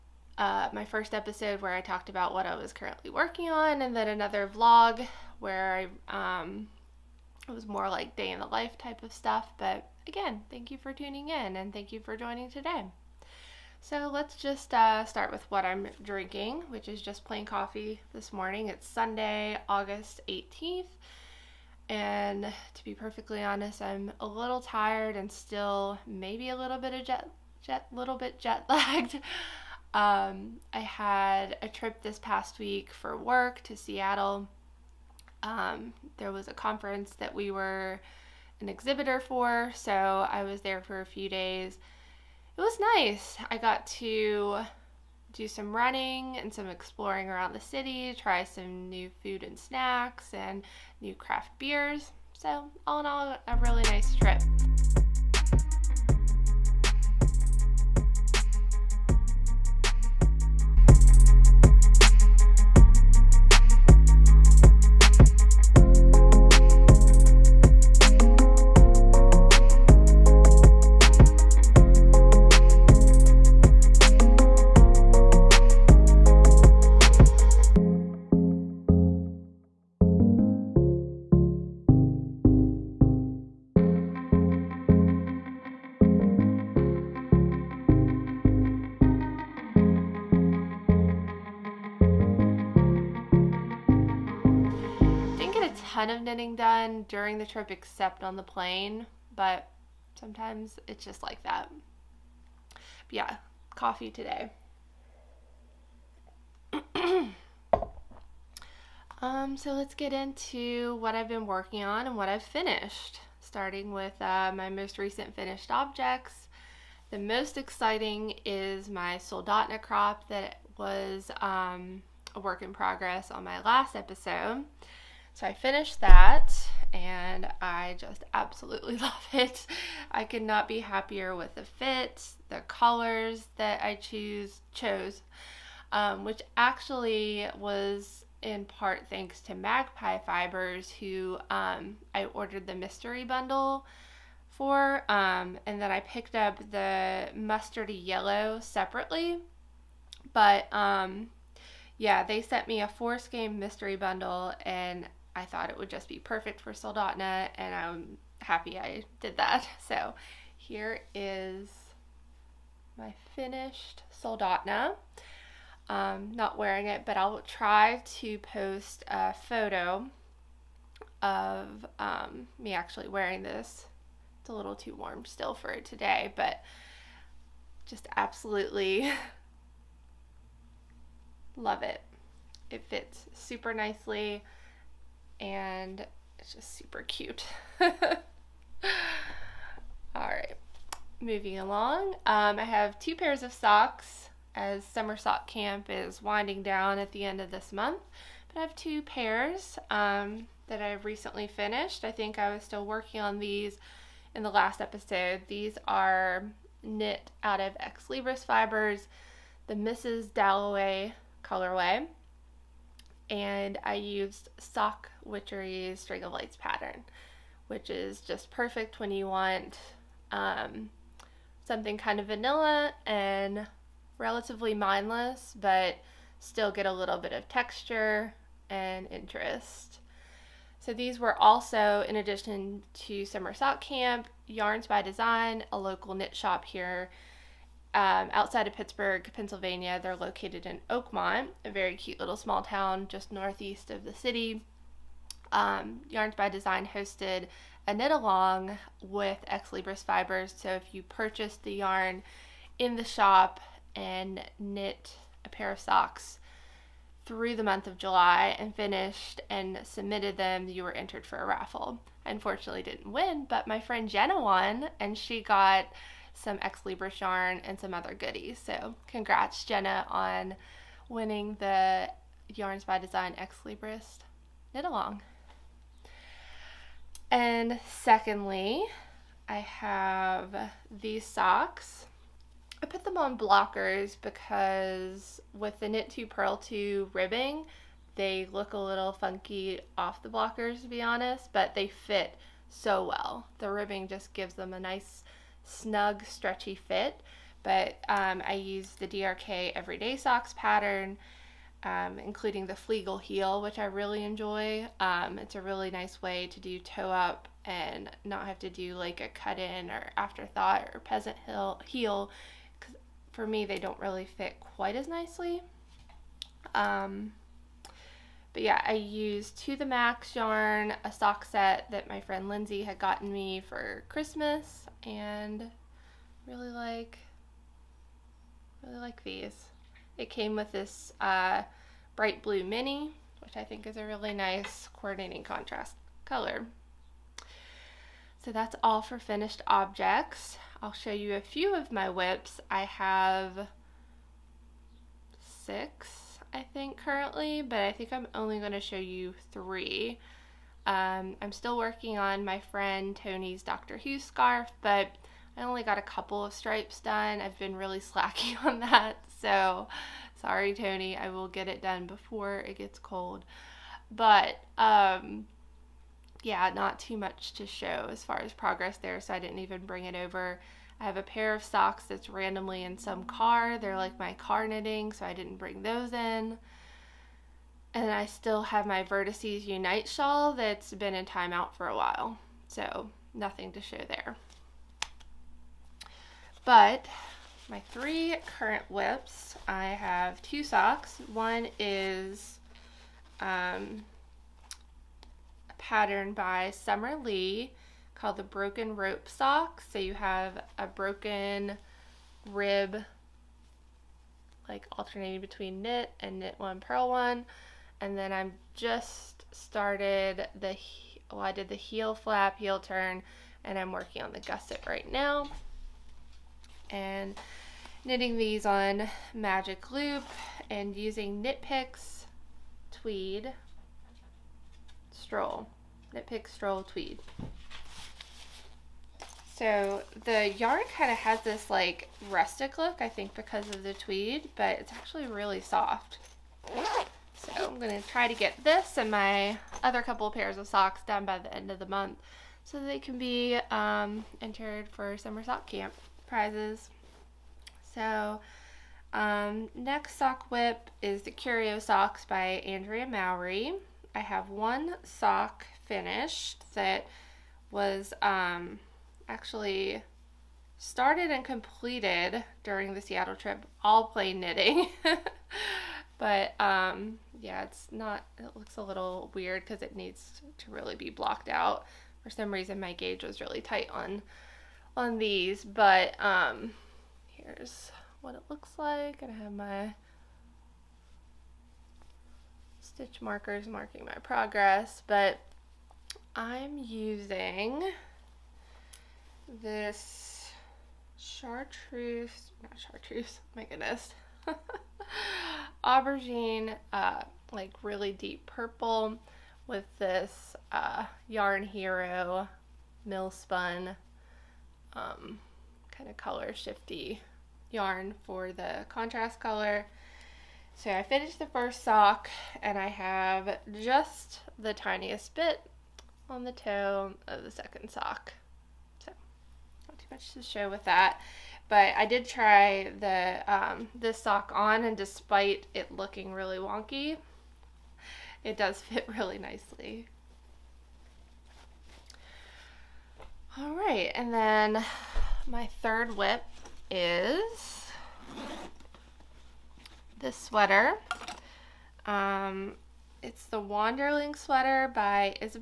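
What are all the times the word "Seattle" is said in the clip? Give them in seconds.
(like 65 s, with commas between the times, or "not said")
33 s, 463 s.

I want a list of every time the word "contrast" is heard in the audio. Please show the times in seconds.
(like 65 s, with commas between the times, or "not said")
335 s, 508 s.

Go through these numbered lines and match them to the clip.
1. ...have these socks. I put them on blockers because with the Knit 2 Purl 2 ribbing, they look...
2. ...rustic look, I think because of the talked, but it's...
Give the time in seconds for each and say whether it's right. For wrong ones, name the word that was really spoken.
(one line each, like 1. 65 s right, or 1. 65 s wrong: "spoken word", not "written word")
1. 279 s right
2. 432 s wrong: "tweed", not "talked".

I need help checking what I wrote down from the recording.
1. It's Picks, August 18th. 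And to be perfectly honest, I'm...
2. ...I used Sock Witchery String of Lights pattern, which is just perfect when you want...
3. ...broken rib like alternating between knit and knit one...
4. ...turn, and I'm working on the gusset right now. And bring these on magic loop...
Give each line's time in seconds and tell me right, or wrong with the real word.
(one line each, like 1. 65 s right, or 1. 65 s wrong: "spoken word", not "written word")
1. 18 s wrong: "Sunday", not "Picks"
2. 213 s right
3. 400 s right
4. 412 s wrong: "knitting", not "bring".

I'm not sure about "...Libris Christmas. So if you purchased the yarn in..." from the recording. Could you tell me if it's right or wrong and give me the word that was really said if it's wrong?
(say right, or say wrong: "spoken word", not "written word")
wrong: "Fibers", not "Christmas".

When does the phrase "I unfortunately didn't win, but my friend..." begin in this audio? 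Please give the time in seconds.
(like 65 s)
262 s.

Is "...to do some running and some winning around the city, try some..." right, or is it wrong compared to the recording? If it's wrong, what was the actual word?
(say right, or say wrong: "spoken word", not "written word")
wrong: "exploring", not "winning".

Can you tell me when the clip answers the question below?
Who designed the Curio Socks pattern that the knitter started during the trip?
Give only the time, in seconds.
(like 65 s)
452 s.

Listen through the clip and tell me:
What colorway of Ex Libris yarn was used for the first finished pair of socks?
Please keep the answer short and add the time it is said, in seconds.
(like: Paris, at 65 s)
Mrs. Dalloway, at 209 s.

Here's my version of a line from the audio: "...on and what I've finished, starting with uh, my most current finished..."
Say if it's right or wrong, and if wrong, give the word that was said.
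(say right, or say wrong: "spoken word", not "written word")
wrong: "recent", not "current".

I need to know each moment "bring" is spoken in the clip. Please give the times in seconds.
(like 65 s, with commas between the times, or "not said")
369 s, 375 s.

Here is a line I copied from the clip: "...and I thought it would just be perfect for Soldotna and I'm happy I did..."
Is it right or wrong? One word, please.
right.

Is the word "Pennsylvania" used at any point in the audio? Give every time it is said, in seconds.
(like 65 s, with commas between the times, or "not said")
239 s.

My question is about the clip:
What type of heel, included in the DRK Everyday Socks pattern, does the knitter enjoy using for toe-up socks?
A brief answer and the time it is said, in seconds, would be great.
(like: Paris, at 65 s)
Fleegle heel, at 302 s.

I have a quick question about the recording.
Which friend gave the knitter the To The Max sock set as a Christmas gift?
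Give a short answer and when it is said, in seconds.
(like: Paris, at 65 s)
Lindsay, at 322 s.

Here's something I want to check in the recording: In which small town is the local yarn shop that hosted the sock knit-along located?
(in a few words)
Oakmont.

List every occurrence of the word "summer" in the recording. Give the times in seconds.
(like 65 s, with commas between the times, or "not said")
194 s, 233 s, 396 s, 445 s.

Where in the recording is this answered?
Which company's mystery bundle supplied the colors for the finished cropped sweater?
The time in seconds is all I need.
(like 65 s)
139 s.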